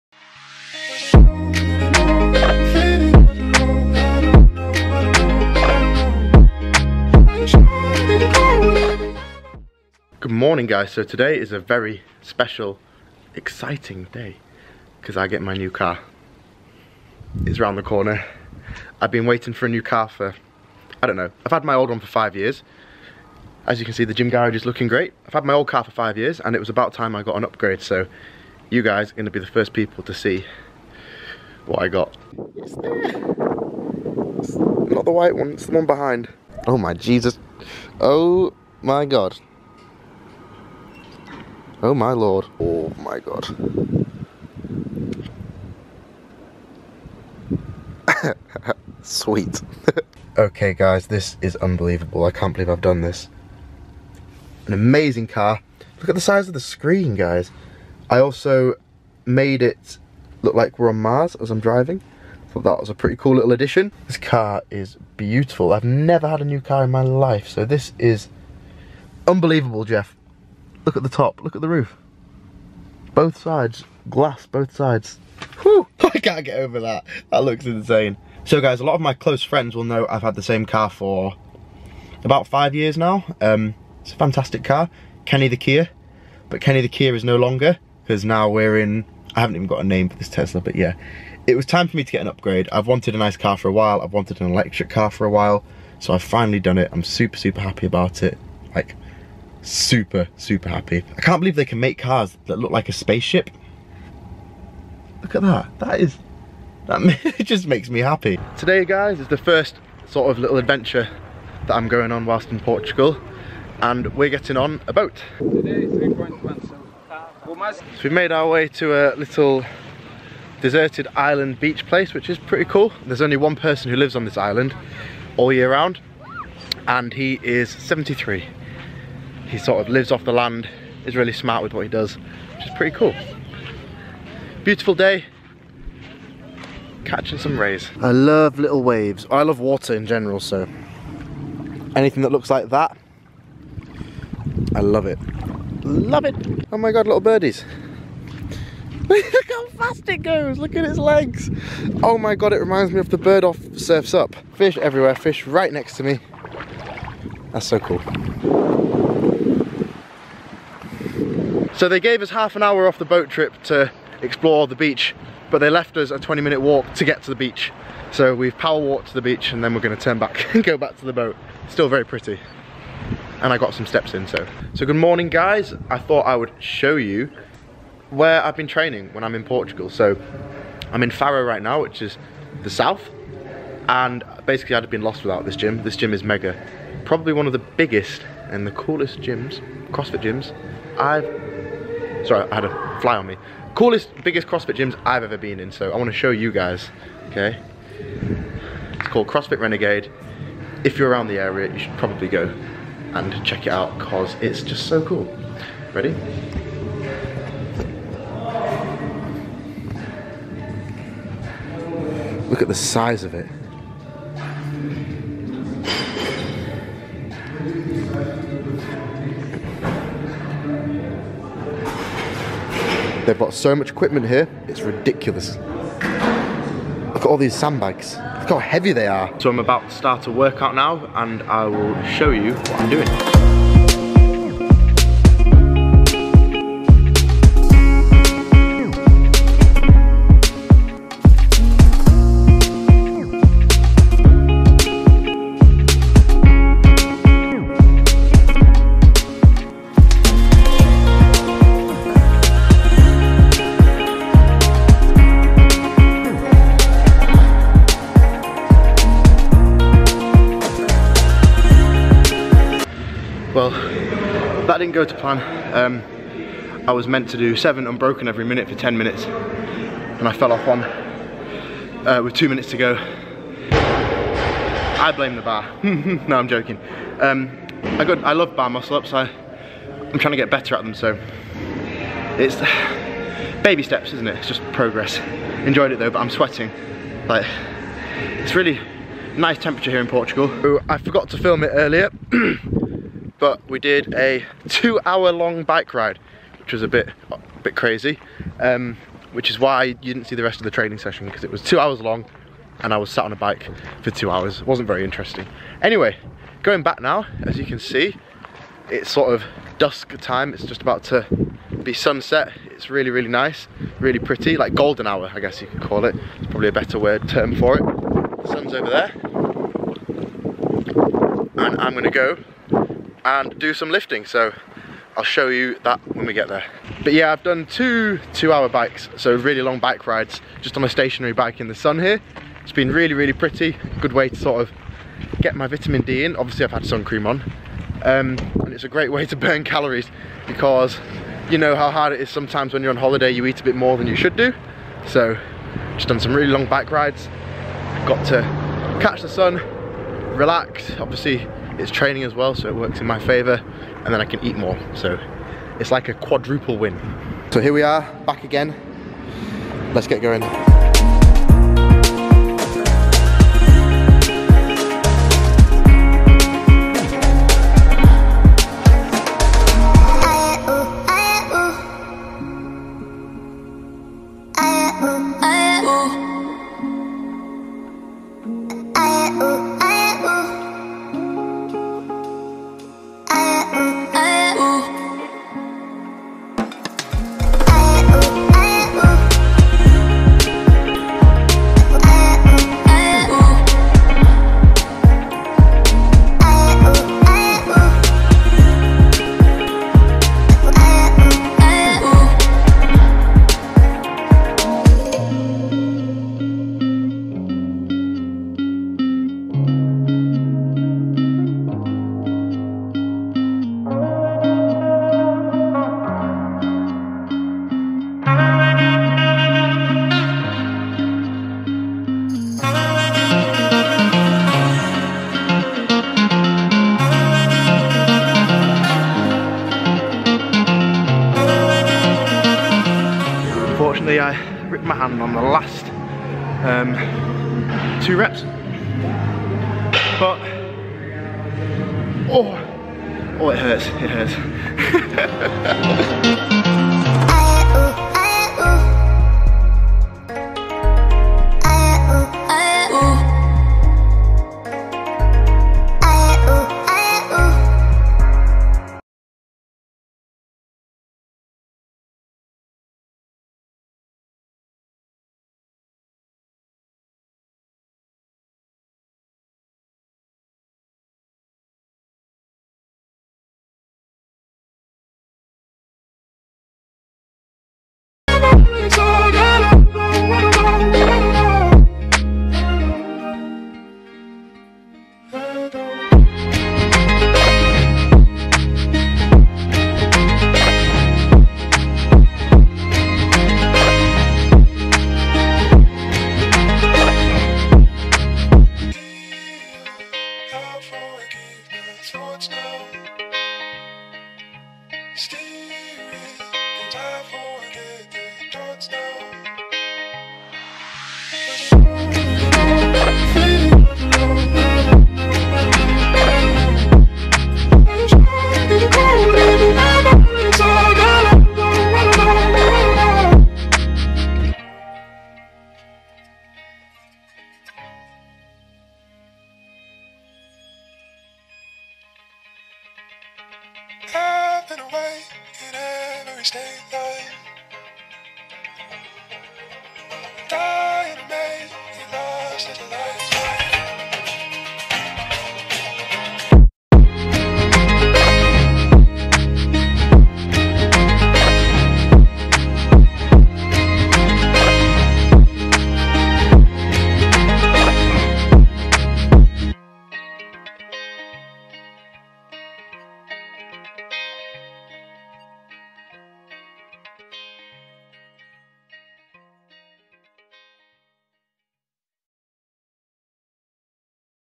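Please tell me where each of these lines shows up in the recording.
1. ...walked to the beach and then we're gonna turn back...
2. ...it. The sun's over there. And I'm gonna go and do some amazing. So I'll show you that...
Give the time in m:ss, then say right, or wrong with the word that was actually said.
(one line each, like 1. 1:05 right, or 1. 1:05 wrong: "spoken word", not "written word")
1. 2:48 right
2. 5:17 wrong: "lifting", not "amazing".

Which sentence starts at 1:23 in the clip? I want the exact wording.
Um, it's a fantastic car, Kenny the Kia.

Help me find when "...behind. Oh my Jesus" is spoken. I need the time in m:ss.
0:35.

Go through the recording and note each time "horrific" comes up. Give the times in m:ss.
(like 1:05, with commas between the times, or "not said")
not said.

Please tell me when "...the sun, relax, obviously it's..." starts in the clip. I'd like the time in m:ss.
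5:49.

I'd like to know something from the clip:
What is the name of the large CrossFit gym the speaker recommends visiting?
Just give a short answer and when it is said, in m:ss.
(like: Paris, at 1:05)
CrossFit Renegade, at 3:19.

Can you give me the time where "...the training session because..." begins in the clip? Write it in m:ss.
5:00.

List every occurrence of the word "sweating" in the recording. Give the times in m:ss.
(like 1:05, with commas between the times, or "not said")
4:46.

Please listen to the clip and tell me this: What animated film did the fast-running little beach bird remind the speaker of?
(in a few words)
Surf's Up.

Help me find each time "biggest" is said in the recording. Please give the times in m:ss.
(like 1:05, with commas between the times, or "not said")
3:07, 3:14.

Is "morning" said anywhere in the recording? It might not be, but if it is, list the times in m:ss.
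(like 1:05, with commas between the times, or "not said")
0:10, 2:54.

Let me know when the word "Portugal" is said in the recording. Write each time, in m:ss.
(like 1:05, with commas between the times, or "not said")
1:52, 2:59, 4:50.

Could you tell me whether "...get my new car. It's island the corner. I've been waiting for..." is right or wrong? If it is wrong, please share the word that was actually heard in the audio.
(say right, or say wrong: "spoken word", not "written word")
wrong: "round", not "island".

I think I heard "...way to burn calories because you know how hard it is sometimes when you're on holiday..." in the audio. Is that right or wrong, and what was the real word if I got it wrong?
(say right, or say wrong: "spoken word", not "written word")
right.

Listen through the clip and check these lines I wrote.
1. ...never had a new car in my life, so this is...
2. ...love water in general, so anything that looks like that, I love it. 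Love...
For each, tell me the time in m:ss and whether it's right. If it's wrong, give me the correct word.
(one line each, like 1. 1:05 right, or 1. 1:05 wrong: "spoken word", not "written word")
1. 1:05 right
2. 2:19 right.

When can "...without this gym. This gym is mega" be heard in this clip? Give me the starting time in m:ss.
3:05.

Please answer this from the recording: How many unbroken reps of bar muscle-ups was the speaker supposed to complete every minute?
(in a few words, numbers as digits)
7.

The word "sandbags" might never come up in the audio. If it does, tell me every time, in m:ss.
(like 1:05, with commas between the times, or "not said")
3:47.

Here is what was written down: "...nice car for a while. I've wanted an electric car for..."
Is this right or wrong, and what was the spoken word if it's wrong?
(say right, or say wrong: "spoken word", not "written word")
right.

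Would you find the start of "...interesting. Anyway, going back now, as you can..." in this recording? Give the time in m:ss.
5:05.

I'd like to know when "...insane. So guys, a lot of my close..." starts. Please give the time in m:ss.
1:17.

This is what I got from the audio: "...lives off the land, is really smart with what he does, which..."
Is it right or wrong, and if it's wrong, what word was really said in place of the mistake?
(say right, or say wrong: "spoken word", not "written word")
right.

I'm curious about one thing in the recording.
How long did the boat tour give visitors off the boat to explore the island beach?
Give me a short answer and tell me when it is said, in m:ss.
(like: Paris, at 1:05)
Half an hour, at 2:42.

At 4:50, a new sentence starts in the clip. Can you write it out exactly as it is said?
Ooh, I forgot to film it earlier.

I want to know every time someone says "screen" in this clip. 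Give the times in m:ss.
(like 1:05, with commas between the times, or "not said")
0:56.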